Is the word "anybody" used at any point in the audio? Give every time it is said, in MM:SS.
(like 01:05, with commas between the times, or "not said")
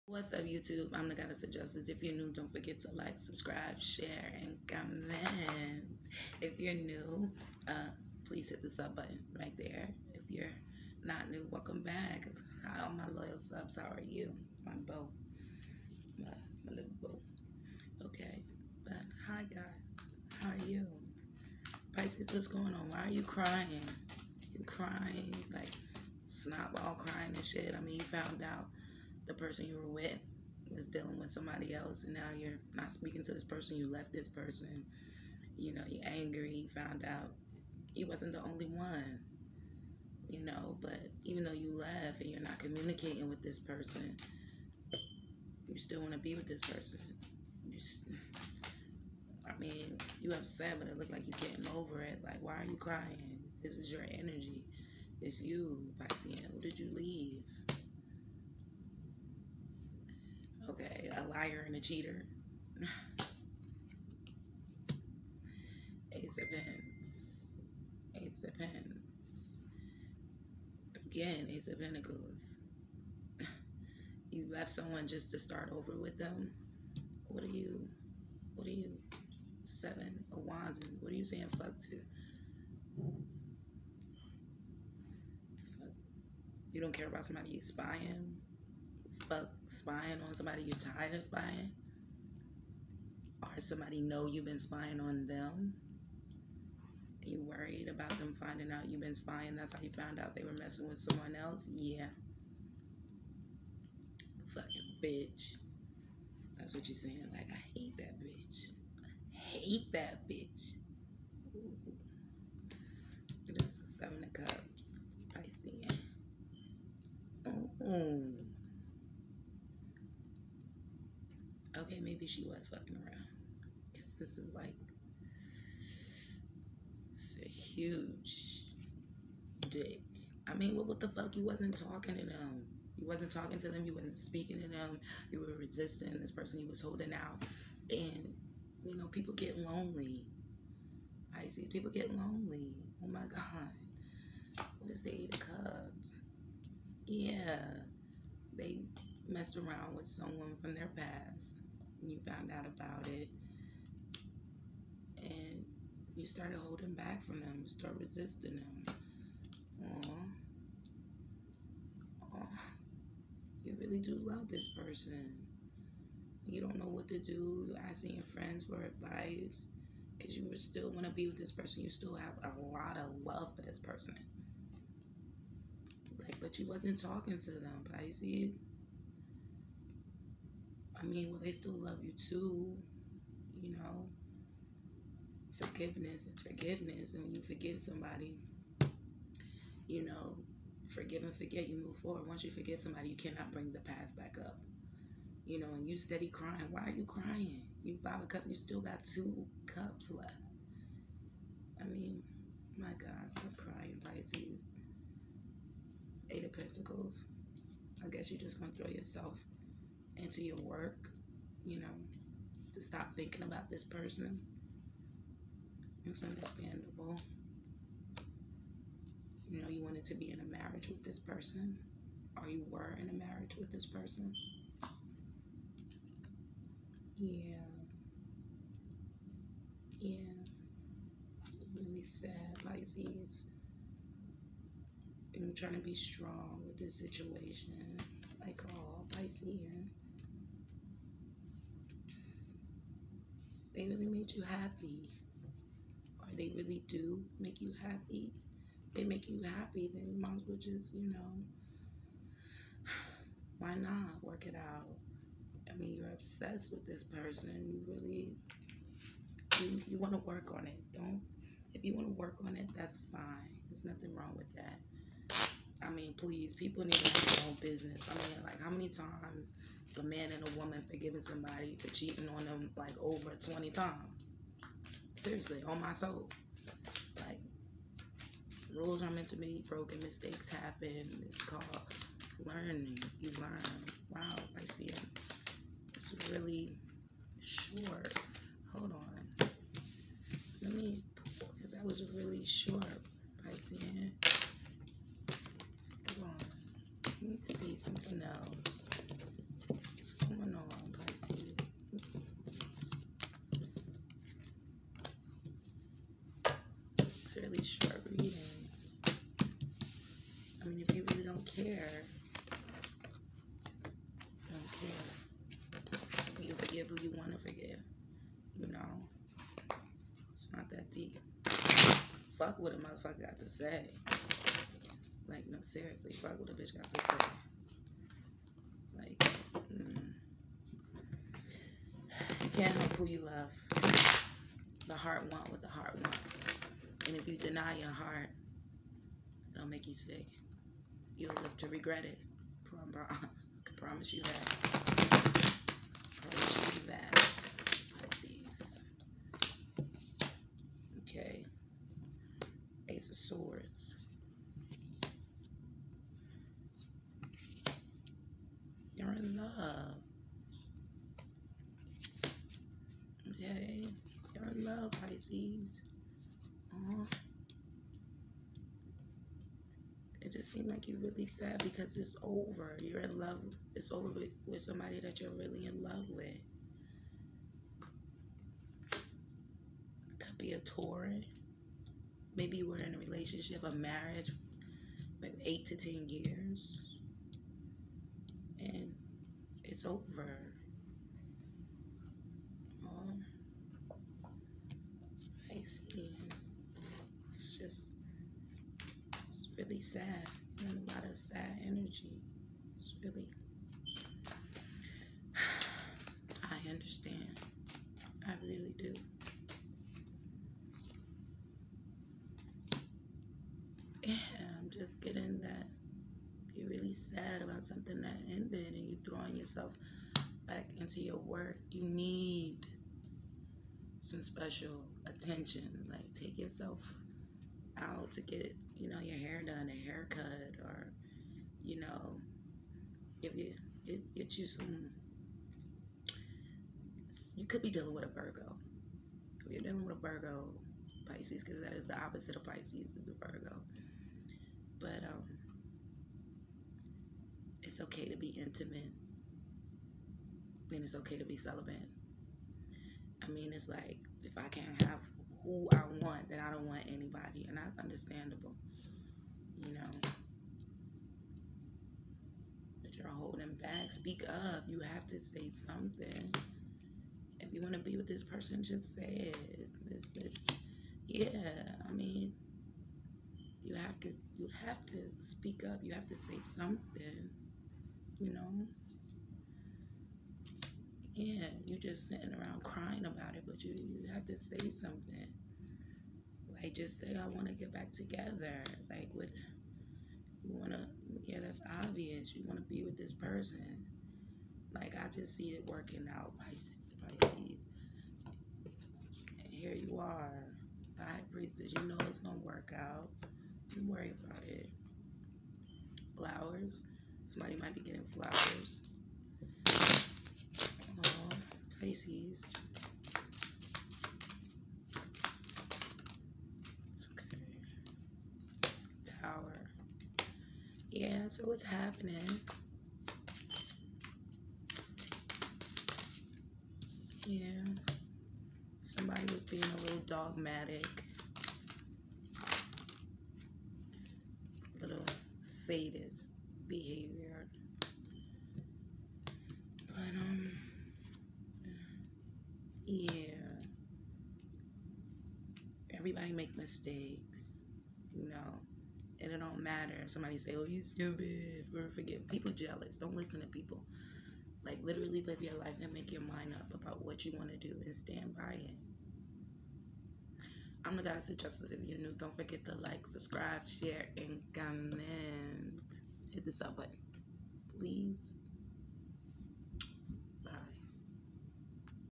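07:36.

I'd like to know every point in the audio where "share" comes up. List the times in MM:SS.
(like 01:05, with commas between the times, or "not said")
00:03, 09:23.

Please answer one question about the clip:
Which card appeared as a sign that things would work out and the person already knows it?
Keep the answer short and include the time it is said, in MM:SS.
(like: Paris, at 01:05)
High Priestess, at 08:20.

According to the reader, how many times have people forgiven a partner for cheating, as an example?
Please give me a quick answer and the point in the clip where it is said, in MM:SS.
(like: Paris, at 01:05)
over 20 times, at 04:33.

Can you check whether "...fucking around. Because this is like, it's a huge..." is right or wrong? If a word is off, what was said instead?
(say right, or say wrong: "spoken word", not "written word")
right.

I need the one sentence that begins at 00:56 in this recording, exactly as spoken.
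who did you leave Okay, a liar and a cheater.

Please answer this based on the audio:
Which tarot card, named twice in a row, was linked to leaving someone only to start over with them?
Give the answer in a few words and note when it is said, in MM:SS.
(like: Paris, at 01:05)
Ace of Pens, at 01:06.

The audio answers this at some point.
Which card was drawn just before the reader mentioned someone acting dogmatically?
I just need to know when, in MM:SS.
08:39.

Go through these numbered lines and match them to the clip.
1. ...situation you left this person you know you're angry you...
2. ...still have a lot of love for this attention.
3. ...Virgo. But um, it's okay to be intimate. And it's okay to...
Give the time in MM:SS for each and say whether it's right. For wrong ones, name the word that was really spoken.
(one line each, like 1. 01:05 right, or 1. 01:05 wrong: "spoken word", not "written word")
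1. 00:33 wrong: "person", not "situation"
2. 02:51 wrong: "person", not "attention"
3. 07:23 right.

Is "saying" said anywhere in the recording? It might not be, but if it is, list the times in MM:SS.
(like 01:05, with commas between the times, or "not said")
01:21, 01:46.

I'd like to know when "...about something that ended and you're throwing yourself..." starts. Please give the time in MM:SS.
06:57.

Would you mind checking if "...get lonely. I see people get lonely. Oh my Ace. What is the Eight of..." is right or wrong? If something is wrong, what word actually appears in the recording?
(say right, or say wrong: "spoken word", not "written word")
wrong: "God", not "Ace".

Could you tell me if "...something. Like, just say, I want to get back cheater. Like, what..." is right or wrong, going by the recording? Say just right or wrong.
wrong.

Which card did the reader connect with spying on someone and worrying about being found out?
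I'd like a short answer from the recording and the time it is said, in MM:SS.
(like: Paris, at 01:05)
Seven of Wands, at 01:19.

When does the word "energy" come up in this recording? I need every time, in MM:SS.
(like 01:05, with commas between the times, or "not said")
00:54, 06:41.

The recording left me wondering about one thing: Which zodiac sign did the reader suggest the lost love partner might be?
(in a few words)
Taurus.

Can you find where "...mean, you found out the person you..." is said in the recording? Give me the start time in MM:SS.
00:27.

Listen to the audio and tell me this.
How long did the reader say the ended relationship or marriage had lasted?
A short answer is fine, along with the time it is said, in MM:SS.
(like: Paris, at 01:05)
8 to 10 years, at 06:25.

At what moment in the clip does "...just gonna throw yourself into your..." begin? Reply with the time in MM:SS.
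03:28.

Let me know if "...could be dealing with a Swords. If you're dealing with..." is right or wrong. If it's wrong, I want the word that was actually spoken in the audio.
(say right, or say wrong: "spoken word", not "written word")
wrong: "Virgo", not "Swords".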